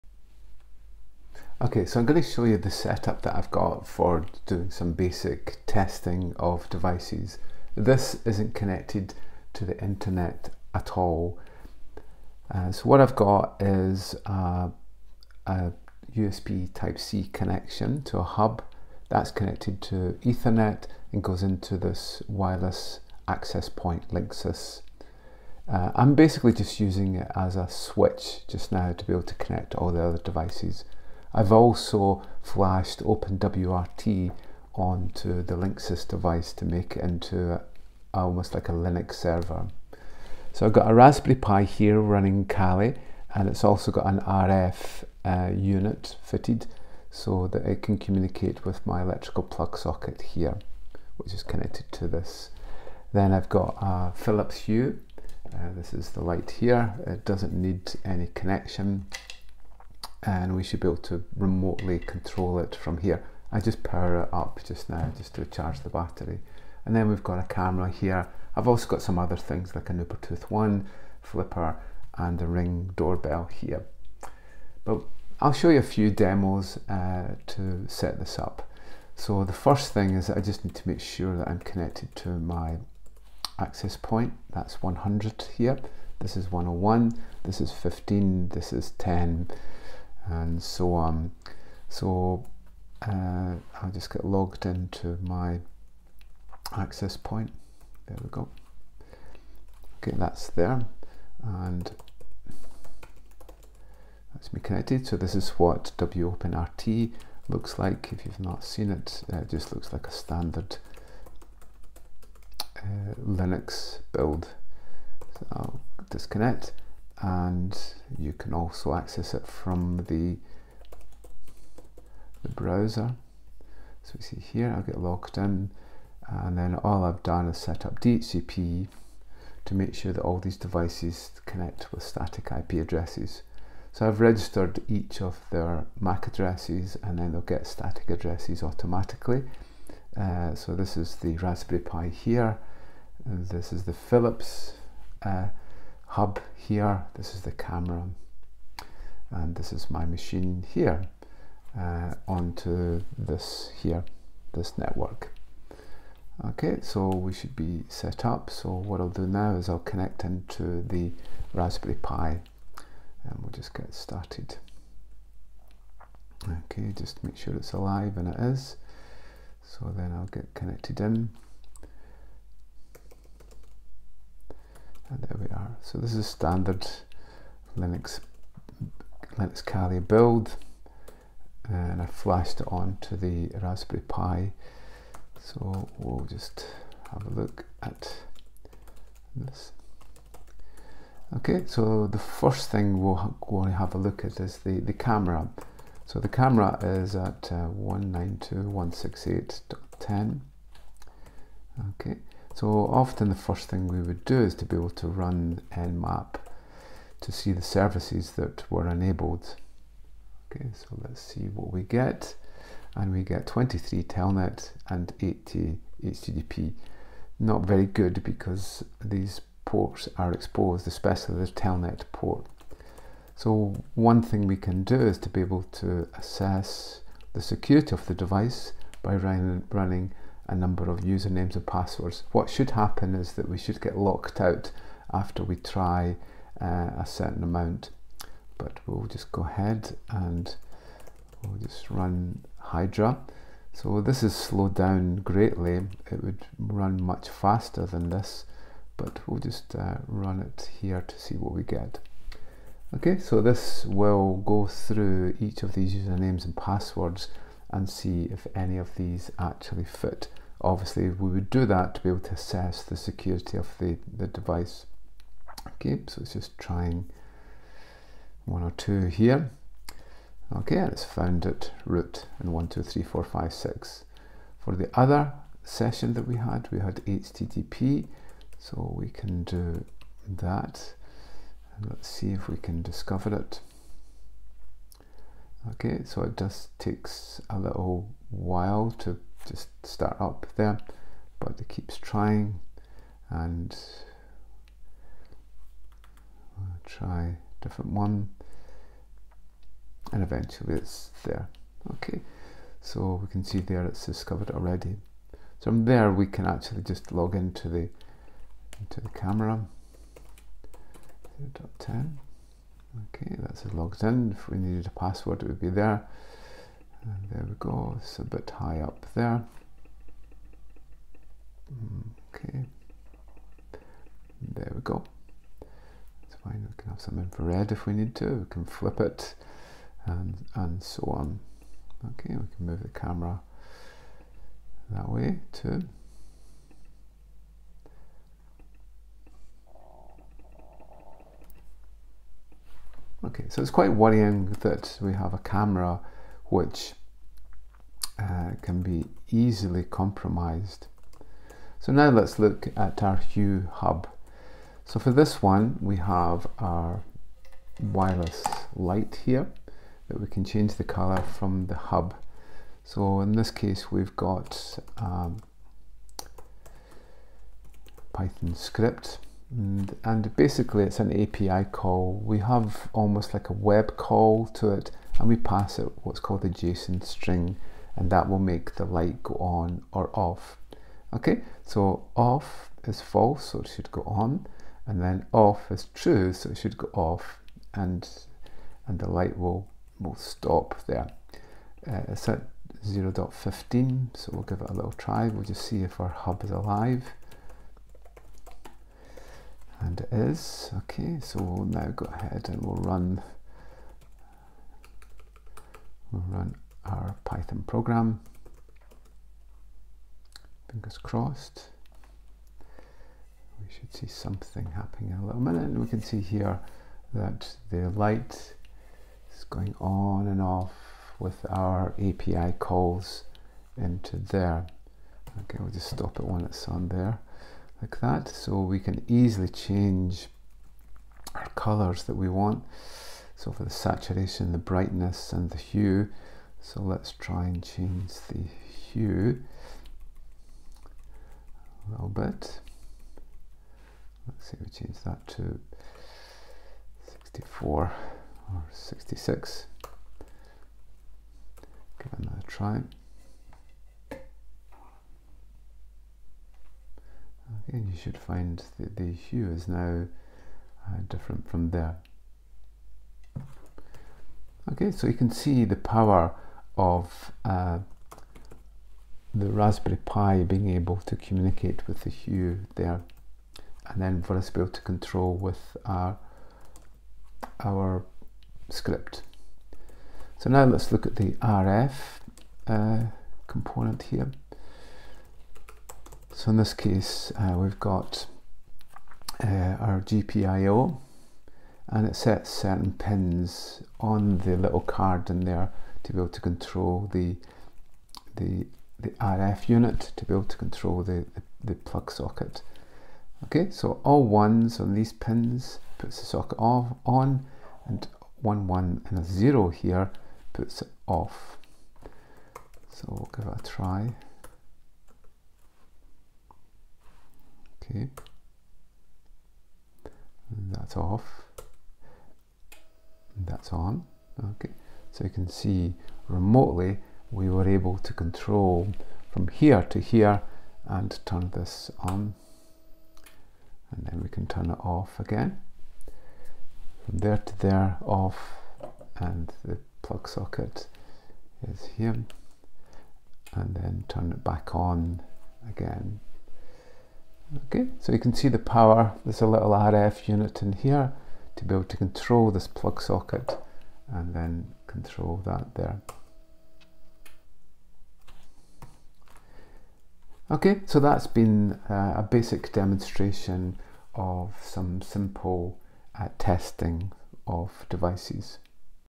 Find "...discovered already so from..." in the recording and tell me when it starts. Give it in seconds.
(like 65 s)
304 s.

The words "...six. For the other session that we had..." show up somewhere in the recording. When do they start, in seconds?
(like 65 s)
273 s.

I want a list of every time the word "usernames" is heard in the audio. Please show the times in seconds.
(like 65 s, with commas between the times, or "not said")
230 s, 255 s.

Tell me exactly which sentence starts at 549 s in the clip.
There's a little RF unit in here to be able to control this plug socket and then control that there.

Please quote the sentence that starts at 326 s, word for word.
It's fine, we can have some infrared if we need to, we can flip it and, and so on.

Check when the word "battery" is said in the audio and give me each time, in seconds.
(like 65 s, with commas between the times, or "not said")
65 s.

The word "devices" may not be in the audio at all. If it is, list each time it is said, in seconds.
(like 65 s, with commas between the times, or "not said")
6 s, 30 s, 36 s, 130 s, 228 s, 264 s, 567 s.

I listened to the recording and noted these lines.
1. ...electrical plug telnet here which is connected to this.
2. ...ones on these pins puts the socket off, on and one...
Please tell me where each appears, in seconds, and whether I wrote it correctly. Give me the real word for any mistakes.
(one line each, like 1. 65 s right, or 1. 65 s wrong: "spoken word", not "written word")
1. 49 s wrong: "socket", not "telnet"
2. 504 s right.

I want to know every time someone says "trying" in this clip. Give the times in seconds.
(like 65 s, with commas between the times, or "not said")
266 s, 291 s.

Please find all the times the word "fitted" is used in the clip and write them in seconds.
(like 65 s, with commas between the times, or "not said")
46 s.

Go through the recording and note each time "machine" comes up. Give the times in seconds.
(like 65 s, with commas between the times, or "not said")
150 s.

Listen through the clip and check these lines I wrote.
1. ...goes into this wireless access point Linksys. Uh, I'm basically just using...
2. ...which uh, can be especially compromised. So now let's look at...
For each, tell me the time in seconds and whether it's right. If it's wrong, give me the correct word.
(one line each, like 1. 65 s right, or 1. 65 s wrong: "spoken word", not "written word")
1. 21 s right
2. 346 s wrong: "easily", not "especially".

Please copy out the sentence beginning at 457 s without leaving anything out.
Again, you should find that the hue is now uh, different from there.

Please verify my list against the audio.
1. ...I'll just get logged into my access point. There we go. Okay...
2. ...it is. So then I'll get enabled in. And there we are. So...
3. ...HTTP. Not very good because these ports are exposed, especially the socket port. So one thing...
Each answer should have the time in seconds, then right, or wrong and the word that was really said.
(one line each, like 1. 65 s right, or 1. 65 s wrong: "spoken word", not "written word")
1. 93 s right
2. 168 s wrong: "connected", not "enabled"
3. 216 s wrong: "telnet", not "socket".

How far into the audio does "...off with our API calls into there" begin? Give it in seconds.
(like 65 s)
420 s.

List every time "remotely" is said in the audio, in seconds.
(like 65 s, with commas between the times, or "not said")
61 s, 526 s.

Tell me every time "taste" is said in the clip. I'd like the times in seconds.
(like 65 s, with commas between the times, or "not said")
not said.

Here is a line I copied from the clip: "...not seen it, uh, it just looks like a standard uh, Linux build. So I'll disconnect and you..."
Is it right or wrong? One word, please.
right.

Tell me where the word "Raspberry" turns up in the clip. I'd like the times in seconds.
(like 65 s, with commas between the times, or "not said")
40 s, 141 s, 161 s, 183 s, 469 s.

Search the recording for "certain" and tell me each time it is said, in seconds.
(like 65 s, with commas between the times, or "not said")
237 s, 492 s.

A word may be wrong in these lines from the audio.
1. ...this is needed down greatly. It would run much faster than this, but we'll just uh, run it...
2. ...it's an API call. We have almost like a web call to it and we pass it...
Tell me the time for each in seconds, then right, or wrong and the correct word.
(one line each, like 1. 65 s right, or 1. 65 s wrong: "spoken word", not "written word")
1. 244 s wrong: "slowed", not "needed"
2. 370 s right.